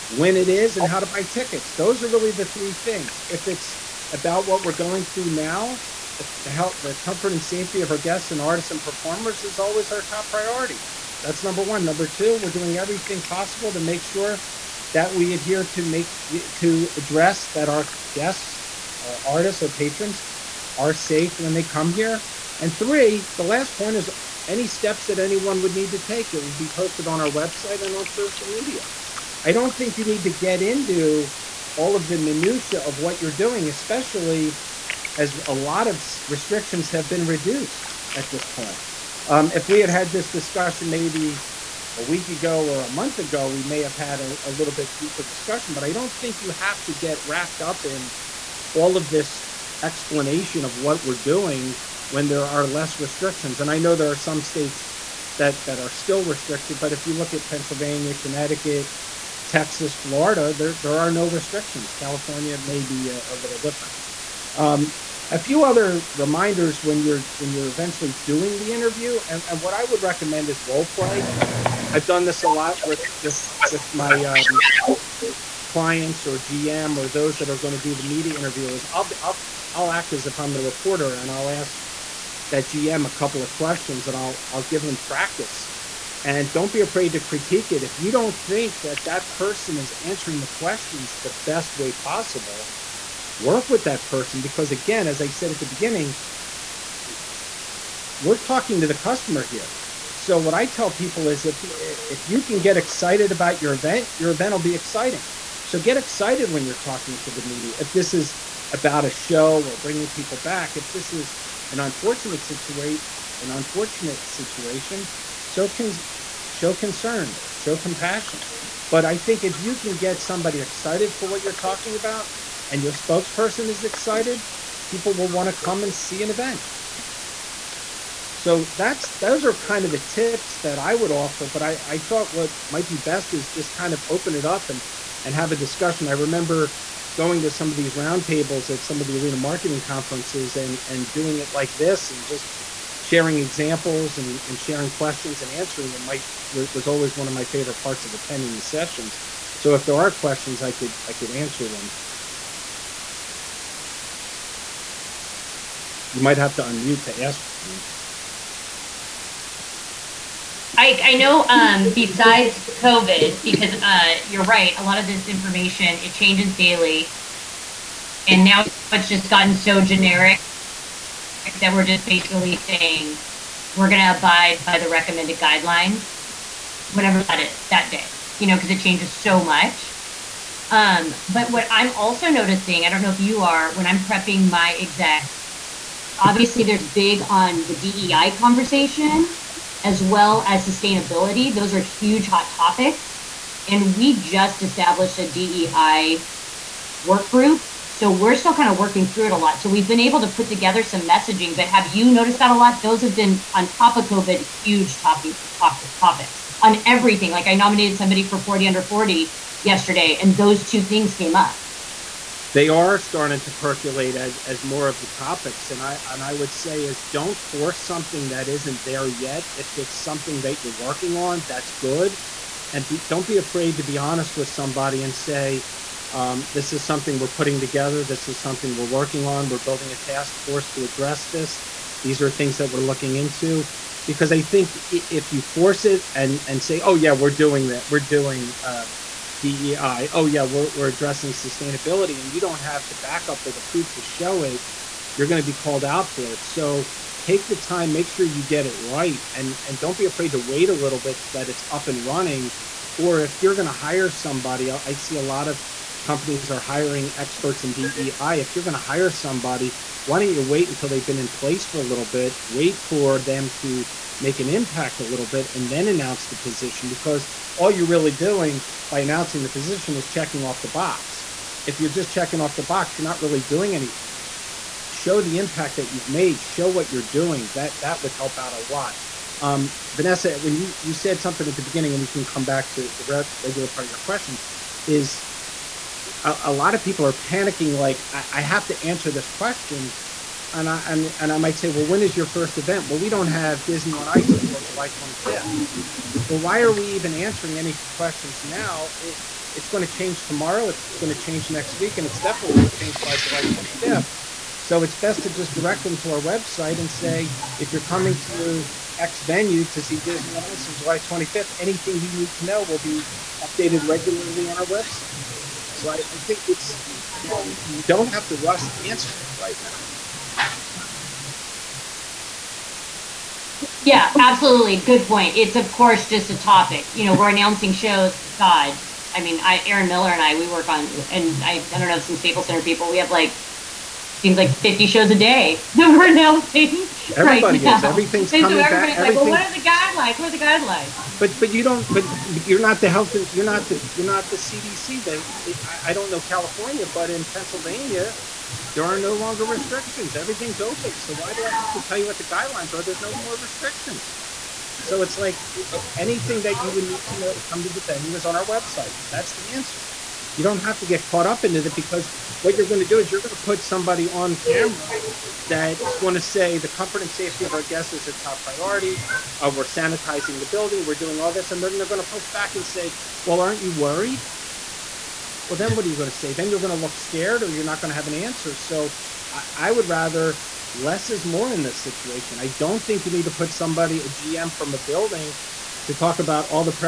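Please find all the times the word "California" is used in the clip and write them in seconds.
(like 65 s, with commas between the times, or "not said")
61 s, 346 s.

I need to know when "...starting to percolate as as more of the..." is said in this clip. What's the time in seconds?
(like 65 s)
212 s.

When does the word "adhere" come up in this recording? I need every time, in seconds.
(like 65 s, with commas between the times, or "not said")
15 s.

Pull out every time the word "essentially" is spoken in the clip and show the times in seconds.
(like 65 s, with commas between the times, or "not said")
not said.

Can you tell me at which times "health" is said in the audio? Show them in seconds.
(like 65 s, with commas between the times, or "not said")
6 s, 342 s.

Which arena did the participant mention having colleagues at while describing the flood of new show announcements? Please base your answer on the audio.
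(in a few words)
Staples Center.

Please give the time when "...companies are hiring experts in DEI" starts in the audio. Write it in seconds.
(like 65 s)
256 s.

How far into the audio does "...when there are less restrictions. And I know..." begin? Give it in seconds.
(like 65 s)
52 s.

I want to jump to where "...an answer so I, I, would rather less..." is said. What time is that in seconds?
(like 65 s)
378 s.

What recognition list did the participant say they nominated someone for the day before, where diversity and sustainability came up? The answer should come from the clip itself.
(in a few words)
40 under 40.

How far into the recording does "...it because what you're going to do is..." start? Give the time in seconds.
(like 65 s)
361 s.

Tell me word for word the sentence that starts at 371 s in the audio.
And then they're going to push back and say, well, aren't you worried?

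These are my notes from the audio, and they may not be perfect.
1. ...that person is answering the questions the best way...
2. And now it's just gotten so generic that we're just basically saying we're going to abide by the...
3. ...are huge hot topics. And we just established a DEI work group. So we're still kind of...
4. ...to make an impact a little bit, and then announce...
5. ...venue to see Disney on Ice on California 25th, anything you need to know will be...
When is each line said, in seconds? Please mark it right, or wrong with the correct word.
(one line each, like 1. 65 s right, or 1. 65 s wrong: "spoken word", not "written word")
1. 89 s right
2. 168 s right
3. 191 s right
4. 263 s right
5. 309 s wrong: "July", not "California".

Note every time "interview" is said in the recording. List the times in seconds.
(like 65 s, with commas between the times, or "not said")
68 s, 78 s.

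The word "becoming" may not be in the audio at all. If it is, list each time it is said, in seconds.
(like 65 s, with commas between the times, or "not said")
not said.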